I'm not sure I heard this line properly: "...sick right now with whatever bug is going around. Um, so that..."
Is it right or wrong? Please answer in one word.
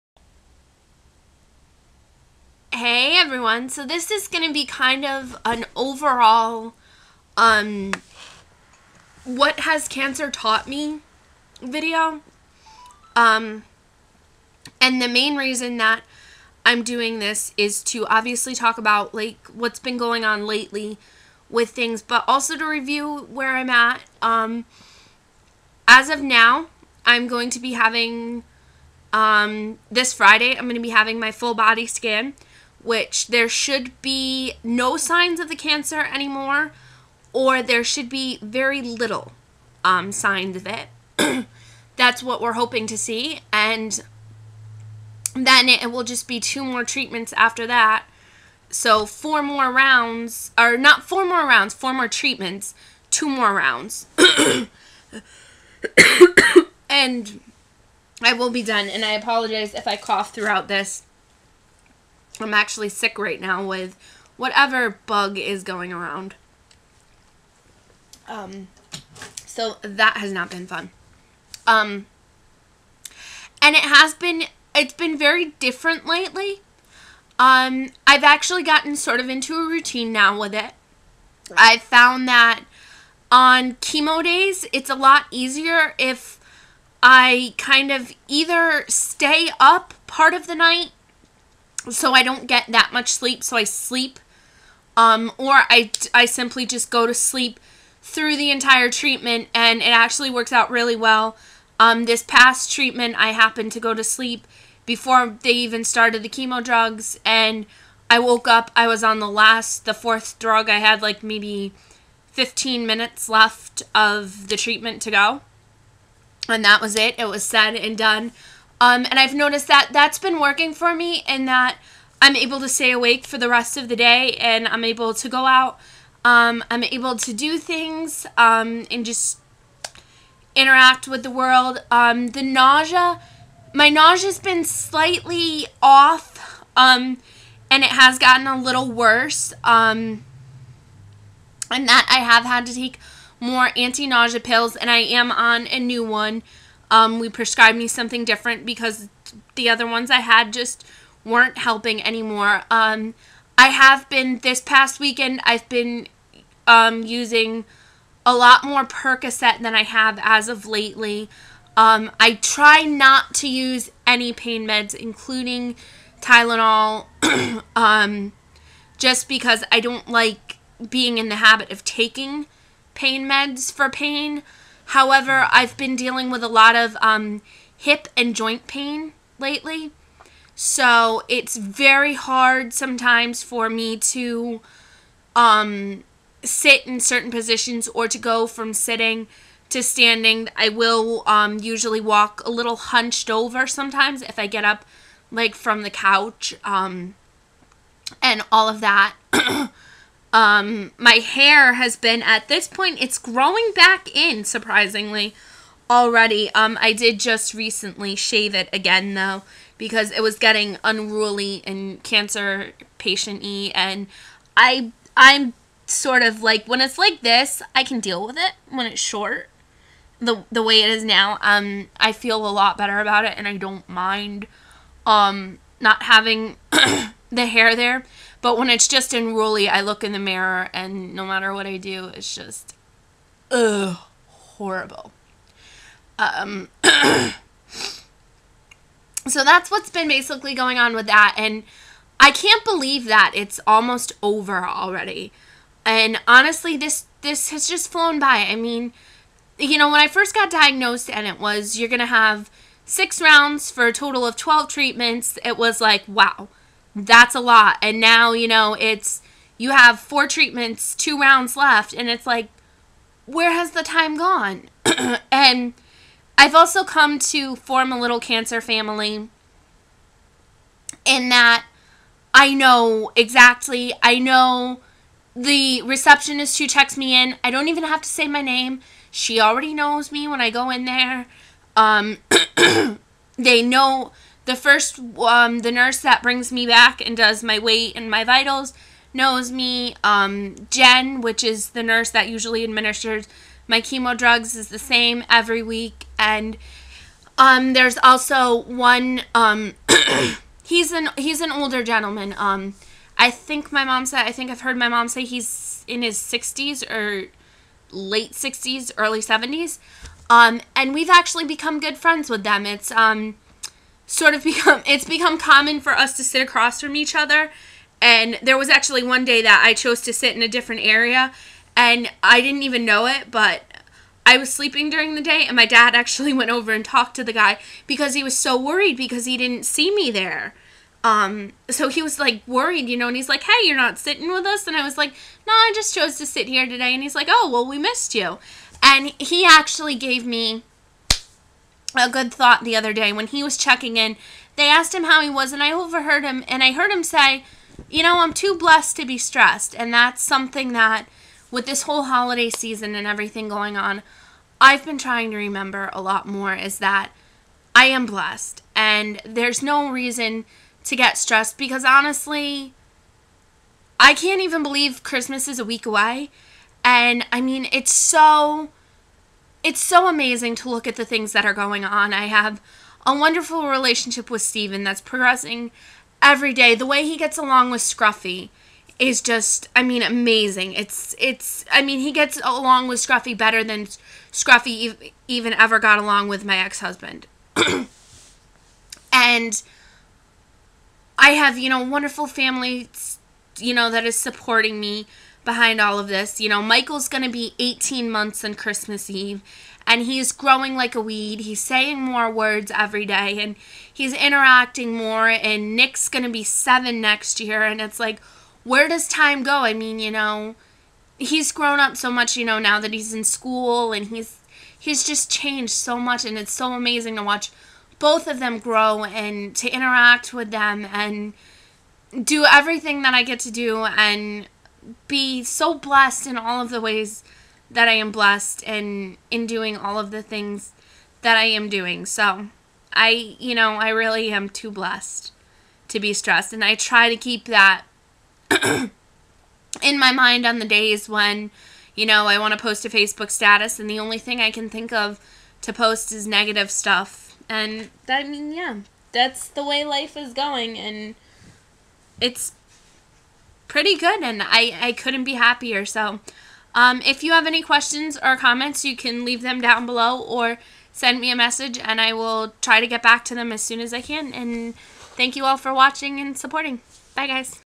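right.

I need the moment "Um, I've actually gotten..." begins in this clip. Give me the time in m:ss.
1:17.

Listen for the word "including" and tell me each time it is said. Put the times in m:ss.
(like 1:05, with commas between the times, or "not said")
2:44.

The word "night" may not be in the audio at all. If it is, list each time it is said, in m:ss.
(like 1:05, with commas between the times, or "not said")
1:30.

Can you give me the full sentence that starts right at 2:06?
Um, I'm able to do things um, and just interact with the world.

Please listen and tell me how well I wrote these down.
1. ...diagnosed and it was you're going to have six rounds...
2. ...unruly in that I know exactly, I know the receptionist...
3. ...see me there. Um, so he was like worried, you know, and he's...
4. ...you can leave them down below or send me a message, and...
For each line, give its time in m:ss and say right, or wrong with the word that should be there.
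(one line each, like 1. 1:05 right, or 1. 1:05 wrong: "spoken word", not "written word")
1. 4:10 right
2. 4:28 wrong: "family", not "unruly"
3. 5:29 right
4. 7:38 right.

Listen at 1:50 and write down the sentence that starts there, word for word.
I had like maybe 15 minutes left of the treatment to go, and that was it.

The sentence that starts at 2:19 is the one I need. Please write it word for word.
Um, and that I have had to take more anti-nausea pills and I am on a new one.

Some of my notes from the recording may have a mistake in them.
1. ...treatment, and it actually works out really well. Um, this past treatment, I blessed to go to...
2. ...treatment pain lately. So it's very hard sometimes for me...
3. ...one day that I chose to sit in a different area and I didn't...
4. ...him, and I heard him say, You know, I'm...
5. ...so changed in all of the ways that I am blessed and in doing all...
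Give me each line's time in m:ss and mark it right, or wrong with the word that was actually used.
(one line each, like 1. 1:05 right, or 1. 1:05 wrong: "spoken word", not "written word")
1. 1:38 wrong: "happened", not "blessed"
2. 2:58 wrong: "joint", not "treatment"
3. 5:19 right
4. 5:46 right
5. 7:05 wrong: "blessed", not "changed".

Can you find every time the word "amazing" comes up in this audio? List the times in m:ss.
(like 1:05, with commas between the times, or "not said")
6:10, 6:20, 6:56.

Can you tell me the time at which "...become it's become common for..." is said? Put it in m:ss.
5:14.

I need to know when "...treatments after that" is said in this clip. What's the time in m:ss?
0:46.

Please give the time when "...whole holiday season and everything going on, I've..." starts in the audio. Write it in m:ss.
5:51.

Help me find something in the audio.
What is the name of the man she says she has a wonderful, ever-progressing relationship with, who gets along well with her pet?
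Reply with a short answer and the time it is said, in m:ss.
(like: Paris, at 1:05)
Steven, at 6:14.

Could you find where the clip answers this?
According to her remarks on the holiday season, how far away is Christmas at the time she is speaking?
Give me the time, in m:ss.
6:05.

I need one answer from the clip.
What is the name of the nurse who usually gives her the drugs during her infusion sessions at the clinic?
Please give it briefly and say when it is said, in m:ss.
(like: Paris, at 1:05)
Jen, at 4:50.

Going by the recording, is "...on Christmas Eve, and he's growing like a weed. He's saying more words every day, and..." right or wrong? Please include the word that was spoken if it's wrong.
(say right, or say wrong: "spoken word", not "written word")
right.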